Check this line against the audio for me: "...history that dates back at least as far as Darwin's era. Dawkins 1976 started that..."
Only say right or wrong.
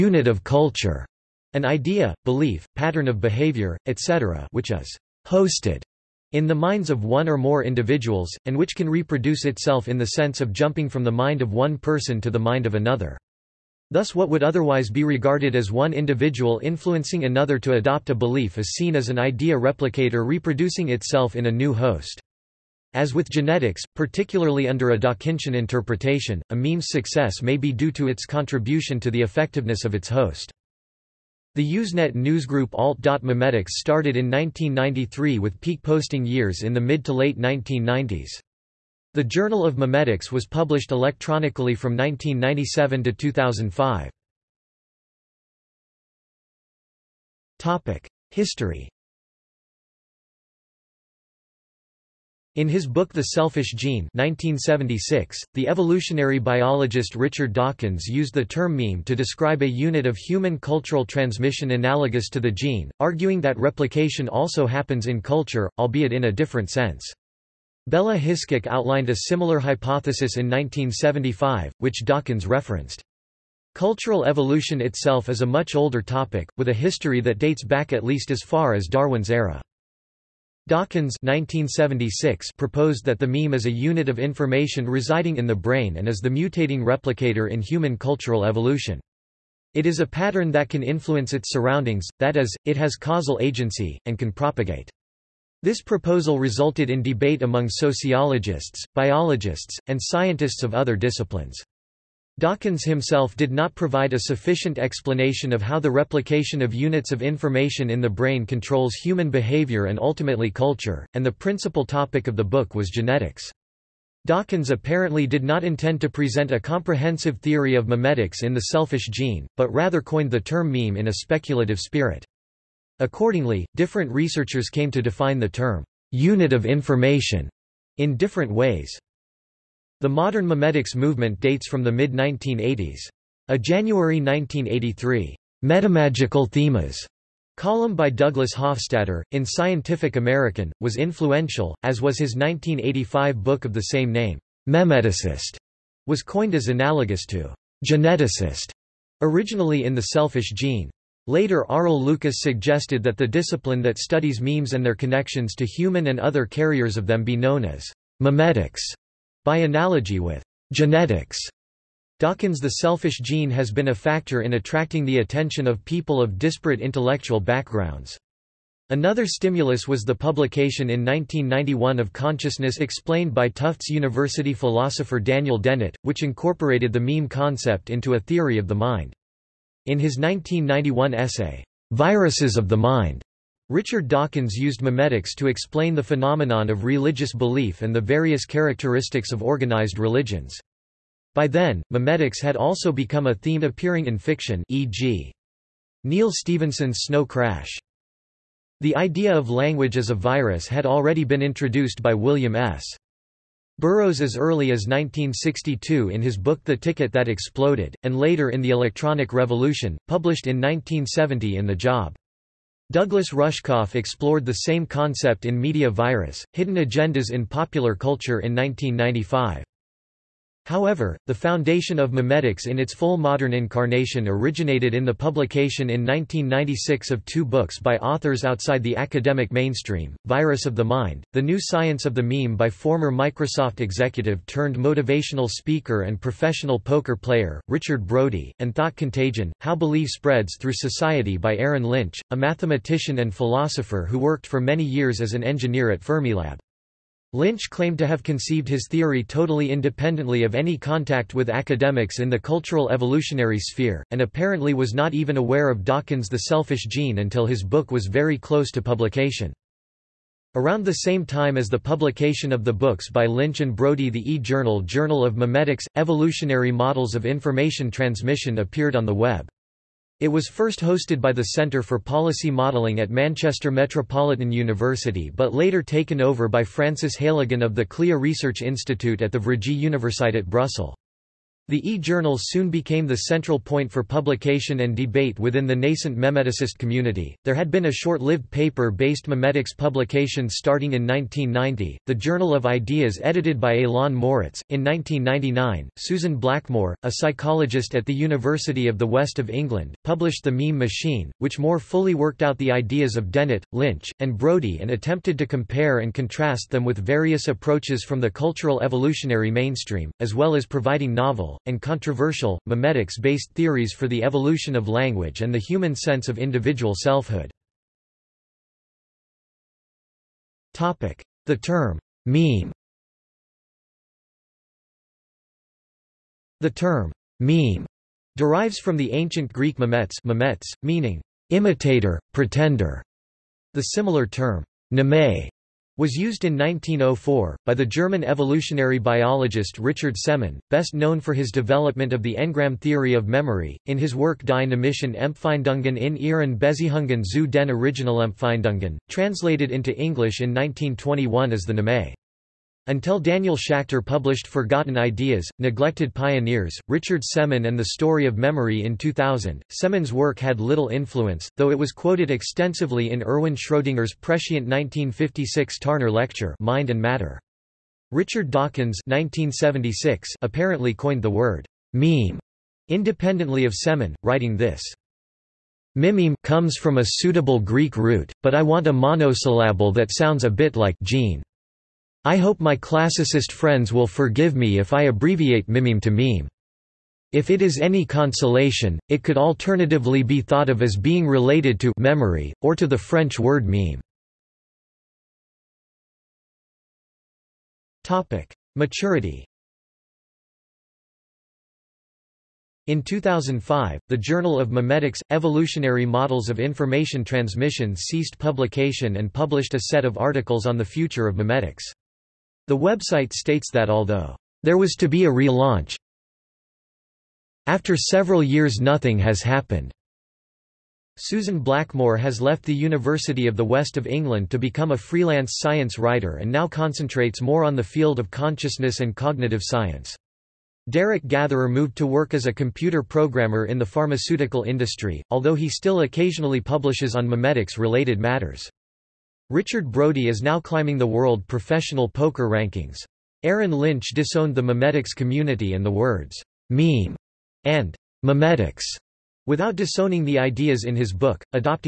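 wrong.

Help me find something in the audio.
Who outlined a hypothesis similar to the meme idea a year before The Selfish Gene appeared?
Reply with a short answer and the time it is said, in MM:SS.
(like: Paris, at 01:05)
Bella Hiskok, at 01:07.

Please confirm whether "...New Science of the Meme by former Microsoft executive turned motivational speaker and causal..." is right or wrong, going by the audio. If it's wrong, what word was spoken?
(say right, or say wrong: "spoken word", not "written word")
wrong: "professional", not "causal".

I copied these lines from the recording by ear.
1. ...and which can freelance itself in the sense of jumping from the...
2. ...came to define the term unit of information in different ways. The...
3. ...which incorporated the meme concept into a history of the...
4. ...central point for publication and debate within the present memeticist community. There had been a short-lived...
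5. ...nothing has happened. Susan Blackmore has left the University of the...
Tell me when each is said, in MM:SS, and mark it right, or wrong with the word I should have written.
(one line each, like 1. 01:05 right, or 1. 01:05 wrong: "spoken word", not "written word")
1. 00:08 wrong: "reproduce", not "freelance"
2. 02:04 right
3. 02:56 wrong: "theory", not "history"
4. 04:43 wrong: "nascent", not "present"
5. 06:58 right.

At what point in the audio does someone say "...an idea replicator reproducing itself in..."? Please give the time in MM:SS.
00:19.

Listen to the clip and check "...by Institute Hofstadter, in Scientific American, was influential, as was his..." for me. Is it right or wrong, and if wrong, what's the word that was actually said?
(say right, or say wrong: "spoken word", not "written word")
wrong: "Douglas", not "Institute".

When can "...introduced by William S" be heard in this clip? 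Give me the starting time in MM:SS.
03:21.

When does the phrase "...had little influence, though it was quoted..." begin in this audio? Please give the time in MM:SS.
06:00.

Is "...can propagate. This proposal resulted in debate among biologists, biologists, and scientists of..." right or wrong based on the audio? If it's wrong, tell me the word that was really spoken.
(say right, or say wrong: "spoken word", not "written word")
wrong: "sociologists", not "biologists".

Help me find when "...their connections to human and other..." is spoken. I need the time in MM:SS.
02:34.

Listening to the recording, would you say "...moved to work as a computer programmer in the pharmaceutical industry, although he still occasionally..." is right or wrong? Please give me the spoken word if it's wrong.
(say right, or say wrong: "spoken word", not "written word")
right.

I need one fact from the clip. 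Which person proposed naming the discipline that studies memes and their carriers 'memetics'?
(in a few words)
Arel Lucas.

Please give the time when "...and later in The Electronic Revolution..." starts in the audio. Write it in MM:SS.
03:28.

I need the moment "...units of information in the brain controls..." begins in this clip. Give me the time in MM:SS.
01:46.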